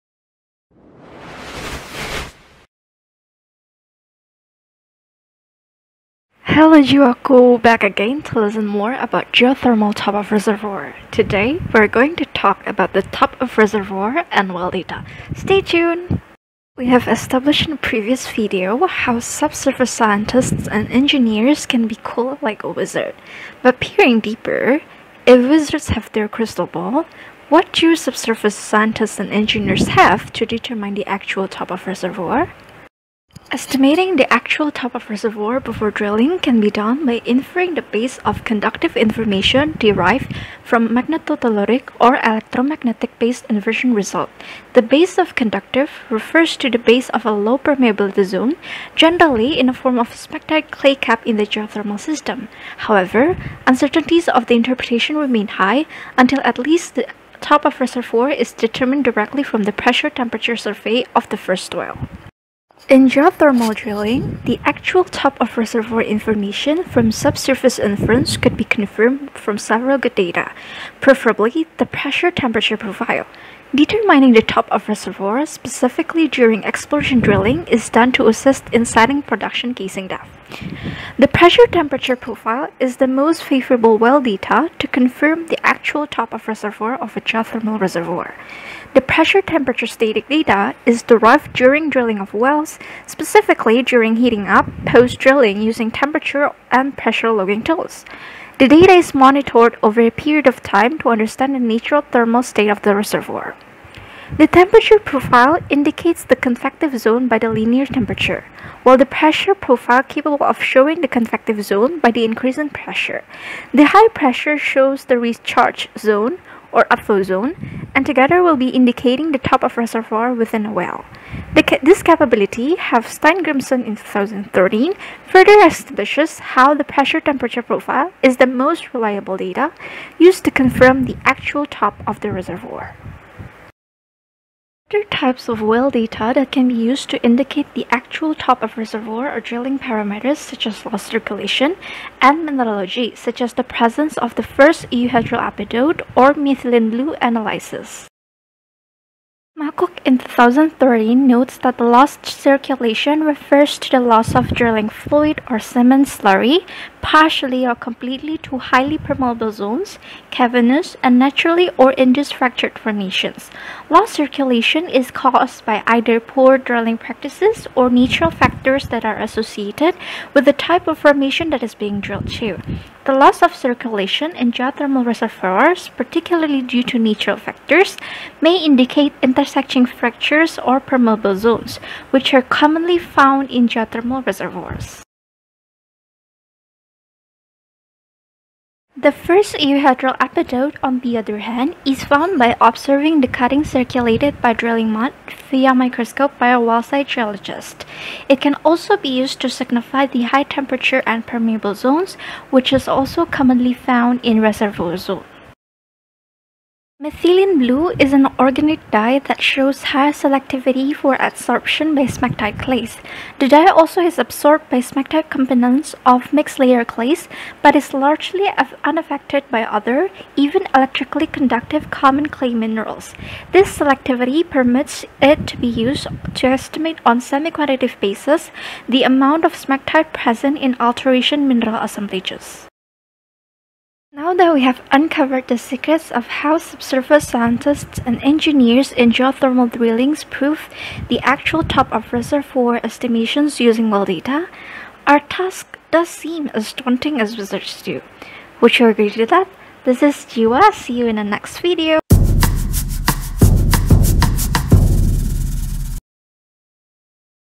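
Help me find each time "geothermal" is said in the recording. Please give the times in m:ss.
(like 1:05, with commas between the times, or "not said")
0:09, 0:51, 1:03, 1:27, 2:54, 3:03, 3:59.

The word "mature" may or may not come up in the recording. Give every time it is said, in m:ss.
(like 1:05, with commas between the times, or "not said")
not said.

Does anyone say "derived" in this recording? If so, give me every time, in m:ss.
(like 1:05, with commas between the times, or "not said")
0:39, 1:31.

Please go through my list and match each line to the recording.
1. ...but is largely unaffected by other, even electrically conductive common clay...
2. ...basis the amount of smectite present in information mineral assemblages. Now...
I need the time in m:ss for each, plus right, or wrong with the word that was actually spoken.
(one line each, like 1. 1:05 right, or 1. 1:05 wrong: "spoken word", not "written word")
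1. 3:37 right
2. 3:47 wrong: "alteration", not "information".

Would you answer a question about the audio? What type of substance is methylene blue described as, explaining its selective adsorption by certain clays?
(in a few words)
organic dye.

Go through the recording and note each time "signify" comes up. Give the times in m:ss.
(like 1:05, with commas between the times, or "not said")
3:19.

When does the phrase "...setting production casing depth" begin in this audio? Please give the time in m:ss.
1:18.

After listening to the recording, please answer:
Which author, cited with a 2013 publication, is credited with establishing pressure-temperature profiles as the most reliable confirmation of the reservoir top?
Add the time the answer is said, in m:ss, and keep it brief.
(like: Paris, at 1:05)
Steingrimsson, at 2:03.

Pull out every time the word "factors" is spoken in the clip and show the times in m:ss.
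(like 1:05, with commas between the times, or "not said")
2:48, 2:57.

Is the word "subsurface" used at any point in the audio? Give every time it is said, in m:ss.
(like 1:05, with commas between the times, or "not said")
0:19, 0:27, 1:07, 3:56.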